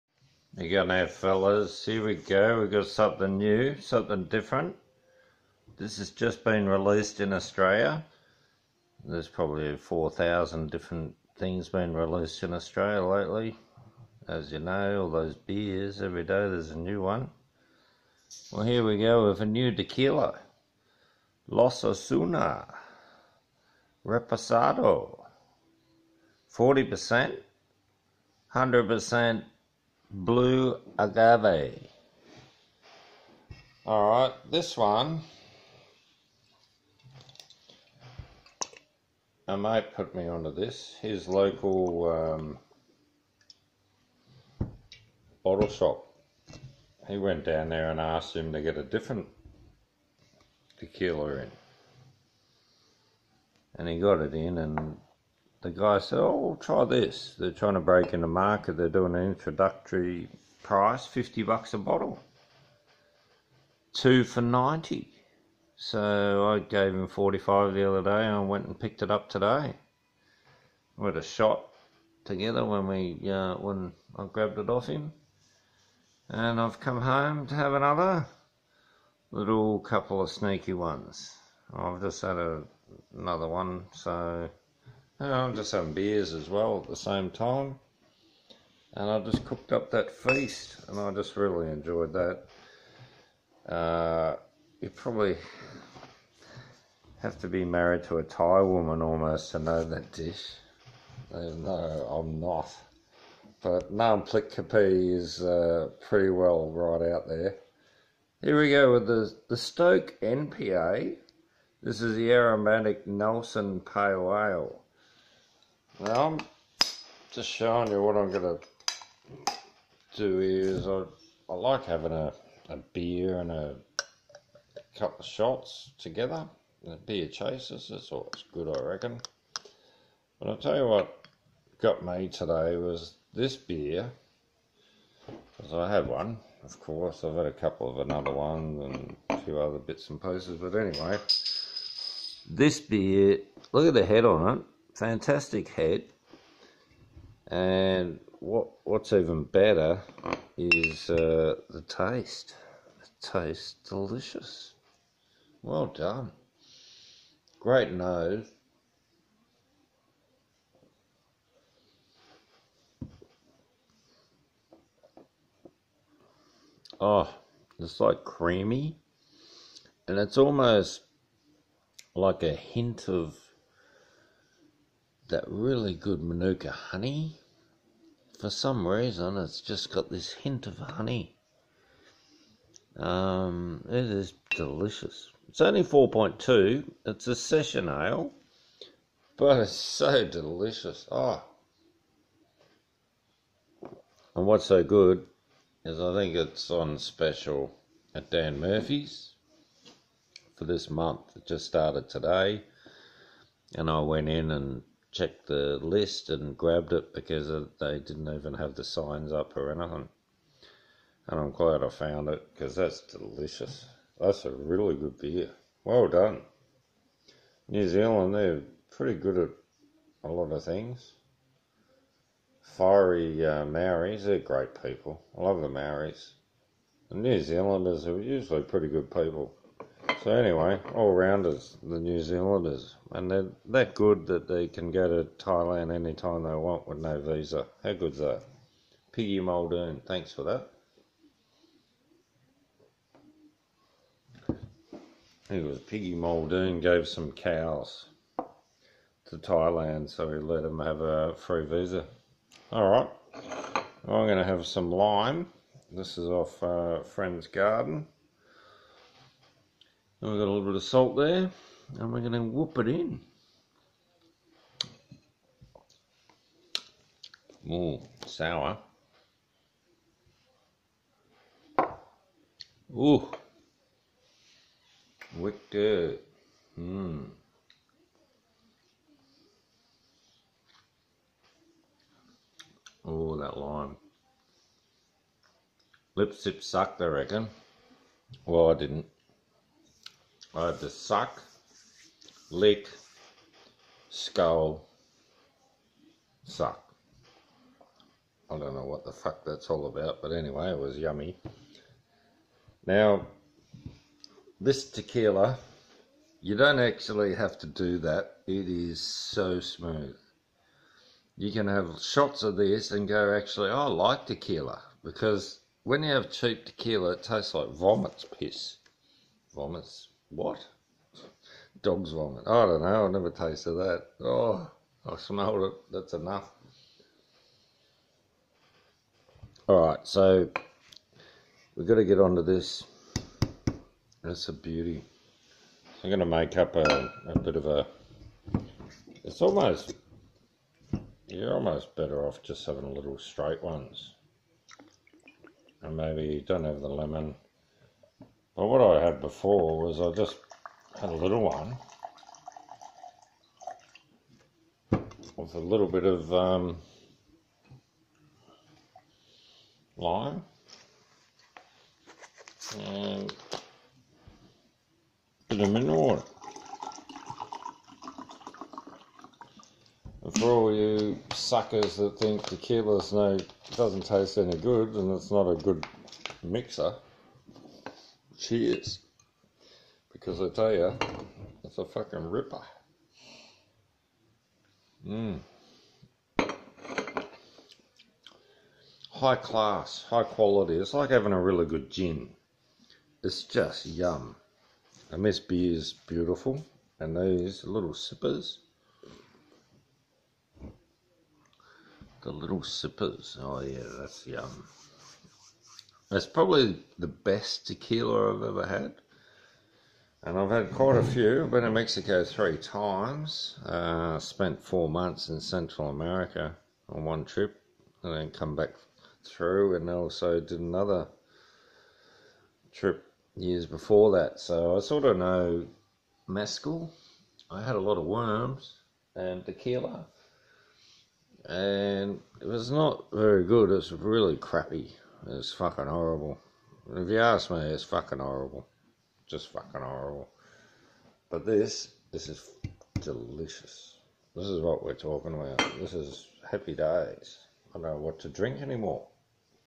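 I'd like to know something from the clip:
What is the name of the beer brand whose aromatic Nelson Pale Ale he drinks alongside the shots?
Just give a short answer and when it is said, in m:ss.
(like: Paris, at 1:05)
Stoke, at 1:49.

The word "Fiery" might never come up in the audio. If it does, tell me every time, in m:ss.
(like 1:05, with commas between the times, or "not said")
3:42.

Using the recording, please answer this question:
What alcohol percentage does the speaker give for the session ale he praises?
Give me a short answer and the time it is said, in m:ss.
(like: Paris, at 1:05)
4.2, at 3:05.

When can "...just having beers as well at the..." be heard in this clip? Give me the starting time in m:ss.
1:25.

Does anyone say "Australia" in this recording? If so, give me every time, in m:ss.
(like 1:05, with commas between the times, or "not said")
0:07, 0:12.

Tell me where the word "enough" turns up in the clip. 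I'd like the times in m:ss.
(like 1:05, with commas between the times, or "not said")
5:26.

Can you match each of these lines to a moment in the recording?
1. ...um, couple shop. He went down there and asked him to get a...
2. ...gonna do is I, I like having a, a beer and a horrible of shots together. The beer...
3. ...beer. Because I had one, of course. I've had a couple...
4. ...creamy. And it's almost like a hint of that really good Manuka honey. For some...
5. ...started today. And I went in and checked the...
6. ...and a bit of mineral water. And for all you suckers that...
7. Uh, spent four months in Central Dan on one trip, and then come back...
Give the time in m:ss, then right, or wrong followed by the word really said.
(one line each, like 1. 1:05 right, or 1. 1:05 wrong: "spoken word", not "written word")
1. 0:42 wrong: "bottle", not "couple"
2. 1:58 wrong: "couple", not "horrible"
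3. 2:13 right
4. 2:48 right
5. 3:21 right
6. 6:02 right
7. 6:53 wrong: "America", not "Dan".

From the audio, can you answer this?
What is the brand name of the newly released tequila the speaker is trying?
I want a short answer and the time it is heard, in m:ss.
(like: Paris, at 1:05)
Los Osuna, at 0:21.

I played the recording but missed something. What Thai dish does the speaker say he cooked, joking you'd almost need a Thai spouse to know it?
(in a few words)
Nam Plik Kapi.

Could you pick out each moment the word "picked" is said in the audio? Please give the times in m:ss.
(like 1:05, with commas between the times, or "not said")
1:08.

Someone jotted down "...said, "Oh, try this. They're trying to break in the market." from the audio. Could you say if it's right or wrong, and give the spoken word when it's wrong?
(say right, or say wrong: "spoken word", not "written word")
right.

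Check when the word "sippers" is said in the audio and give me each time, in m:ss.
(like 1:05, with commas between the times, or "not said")
6:37, 6:42.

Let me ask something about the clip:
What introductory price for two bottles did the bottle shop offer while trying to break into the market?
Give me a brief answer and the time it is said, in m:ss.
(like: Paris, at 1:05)
$90, at 1:03.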